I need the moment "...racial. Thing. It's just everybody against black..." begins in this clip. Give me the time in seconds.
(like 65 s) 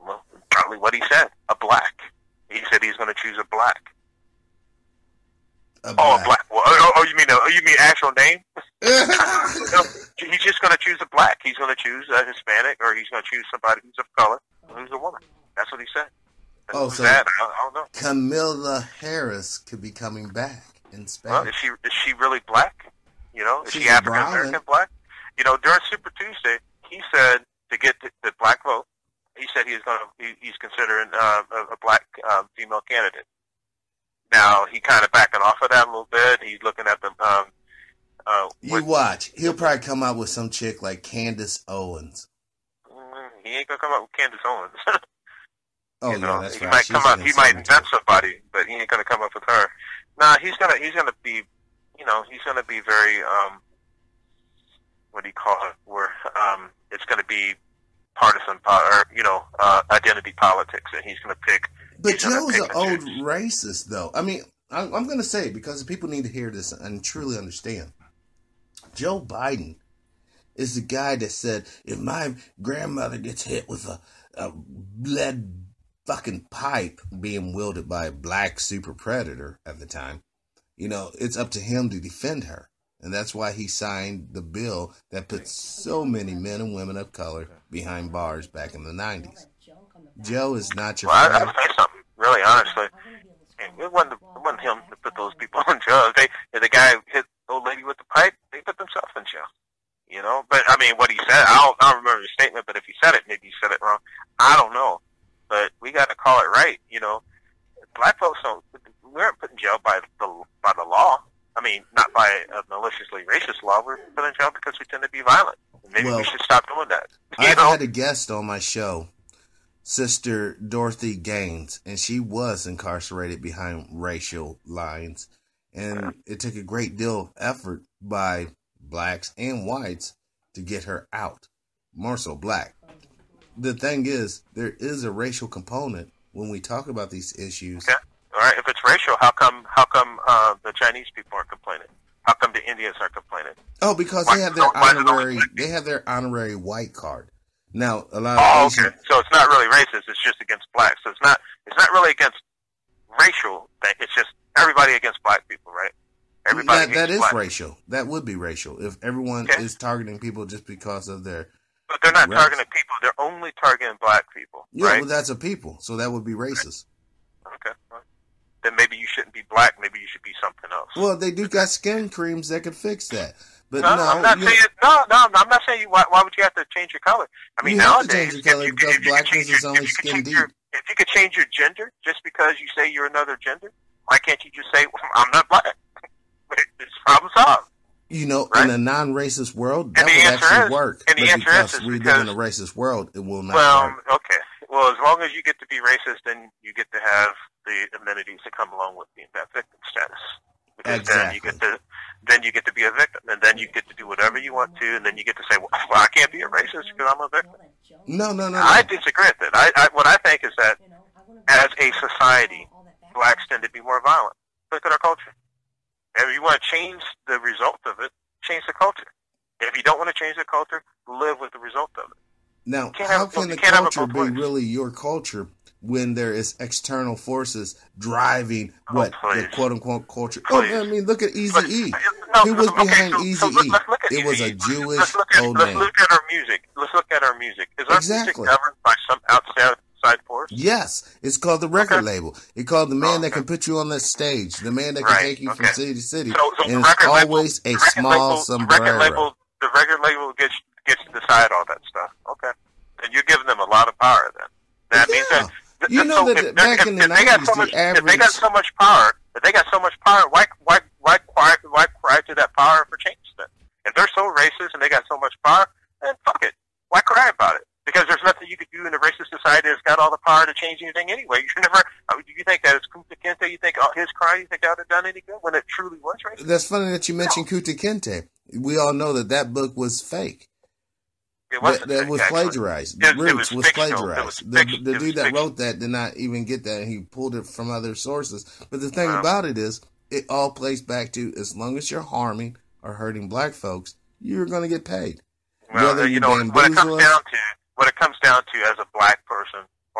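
153 s.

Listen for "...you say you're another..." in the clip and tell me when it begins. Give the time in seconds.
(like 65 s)
182 s.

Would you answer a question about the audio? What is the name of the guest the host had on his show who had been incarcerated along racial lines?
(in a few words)
Dorothy Gaines.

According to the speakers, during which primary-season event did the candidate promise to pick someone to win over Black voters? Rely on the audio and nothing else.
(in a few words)
Super Tuesday.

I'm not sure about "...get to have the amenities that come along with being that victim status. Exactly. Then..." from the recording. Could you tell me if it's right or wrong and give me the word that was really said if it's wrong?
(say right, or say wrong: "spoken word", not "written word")
right.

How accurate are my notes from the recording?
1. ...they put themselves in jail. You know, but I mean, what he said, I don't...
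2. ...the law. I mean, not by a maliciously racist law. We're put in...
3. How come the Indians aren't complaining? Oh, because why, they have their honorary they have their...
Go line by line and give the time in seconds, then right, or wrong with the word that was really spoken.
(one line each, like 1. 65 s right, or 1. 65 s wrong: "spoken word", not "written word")
1. 98 s right
2. 110 s right
3. 142 s right.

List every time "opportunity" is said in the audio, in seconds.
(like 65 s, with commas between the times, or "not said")
not said.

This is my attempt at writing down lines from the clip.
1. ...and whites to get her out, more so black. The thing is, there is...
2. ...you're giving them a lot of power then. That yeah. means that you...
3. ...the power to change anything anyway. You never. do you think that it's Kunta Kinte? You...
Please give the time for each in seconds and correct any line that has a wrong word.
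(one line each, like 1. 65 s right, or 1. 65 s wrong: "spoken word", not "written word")
1. 129 s right
2. 253 s right
3. 270 s right.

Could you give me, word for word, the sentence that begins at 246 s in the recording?
So, and it's always label, a small label, sombrero.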